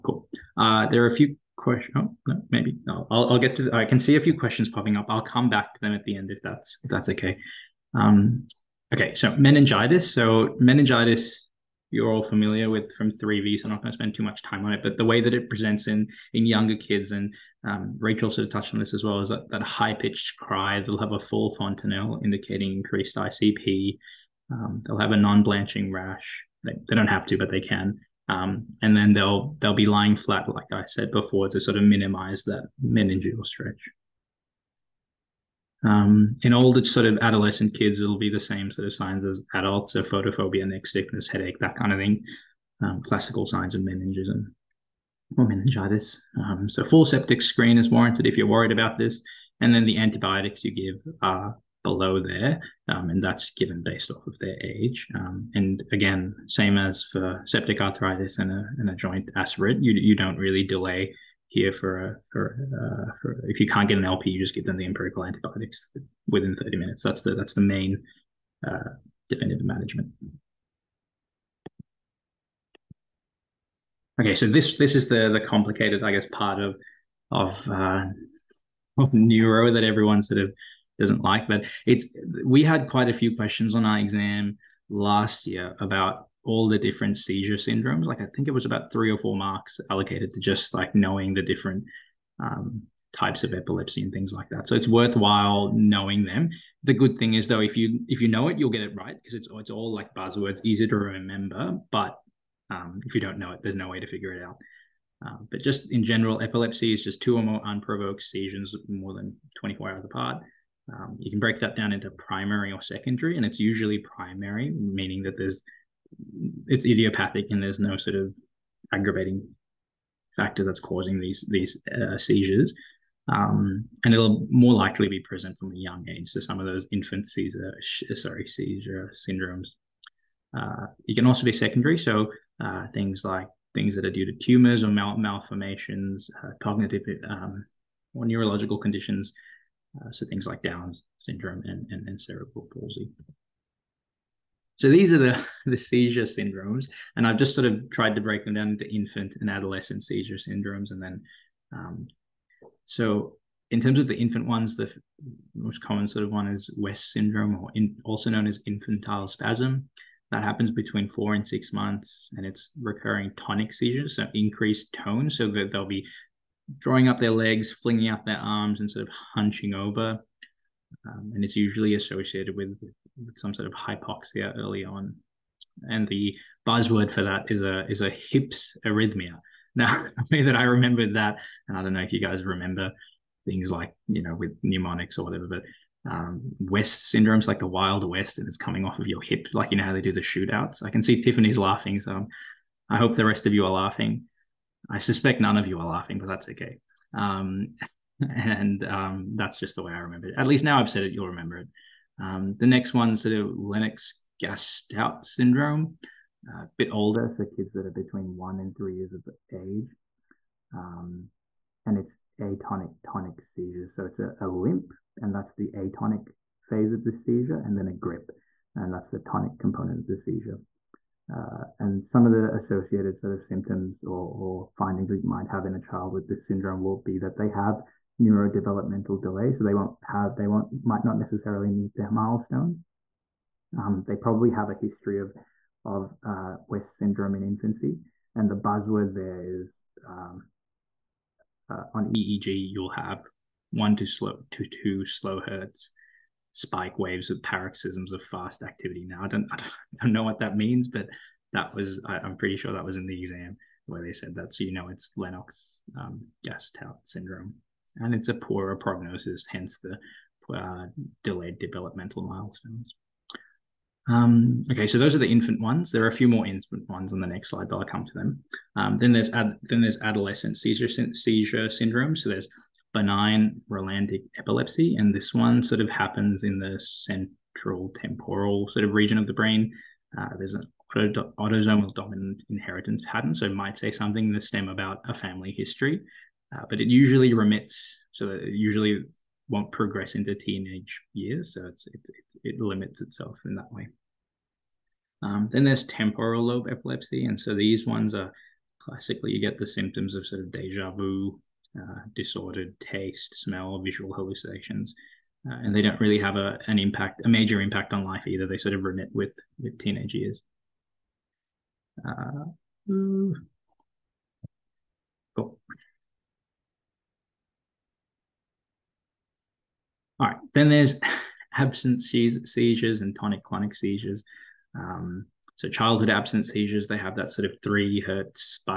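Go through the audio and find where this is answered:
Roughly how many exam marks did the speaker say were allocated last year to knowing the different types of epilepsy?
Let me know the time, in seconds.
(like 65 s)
88 s.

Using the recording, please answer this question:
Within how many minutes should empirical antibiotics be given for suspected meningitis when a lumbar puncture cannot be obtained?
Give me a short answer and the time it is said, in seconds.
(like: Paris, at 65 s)
30 minutes, at 66 s.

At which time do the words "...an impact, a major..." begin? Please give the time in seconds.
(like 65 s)
306 s.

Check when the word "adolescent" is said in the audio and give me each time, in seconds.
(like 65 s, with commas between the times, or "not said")
37 s, 149 s, 269 s.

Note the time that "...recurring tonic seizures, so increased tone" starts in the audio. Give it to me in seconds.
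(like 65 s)
162 s.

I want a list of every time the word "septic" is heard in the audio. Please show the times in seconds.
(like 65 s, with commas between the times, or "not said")
47 s, 57 s.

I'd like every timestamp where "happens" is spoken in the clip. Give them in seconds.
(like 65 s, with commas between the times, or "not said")
160 s, 275 s.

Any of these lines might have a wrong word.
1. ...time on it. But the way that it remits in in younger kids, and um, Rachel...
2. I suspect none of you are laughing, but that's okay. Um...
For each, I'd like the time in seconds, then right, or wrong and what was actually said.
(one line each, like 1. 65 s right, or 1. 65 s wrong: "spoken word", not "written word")
1. 14 s wrong: "presents", not "remits"
2. 194 s right.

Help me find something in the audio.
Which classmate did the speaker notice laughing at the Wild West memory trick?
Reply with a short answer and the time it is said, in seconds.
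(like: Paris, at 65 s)
Tiffany, at 191 s.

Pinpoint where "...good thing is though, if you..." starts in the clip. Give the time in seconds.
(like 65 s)
96 s.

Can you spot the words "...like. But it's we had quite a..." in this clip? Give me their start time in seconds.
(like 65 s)
81 s.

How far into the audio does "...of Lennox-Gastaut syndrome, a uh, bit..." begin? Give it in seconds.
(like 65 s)
203 s.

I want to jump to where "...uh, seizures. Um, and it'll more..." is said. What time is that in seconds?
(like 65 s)
121 s.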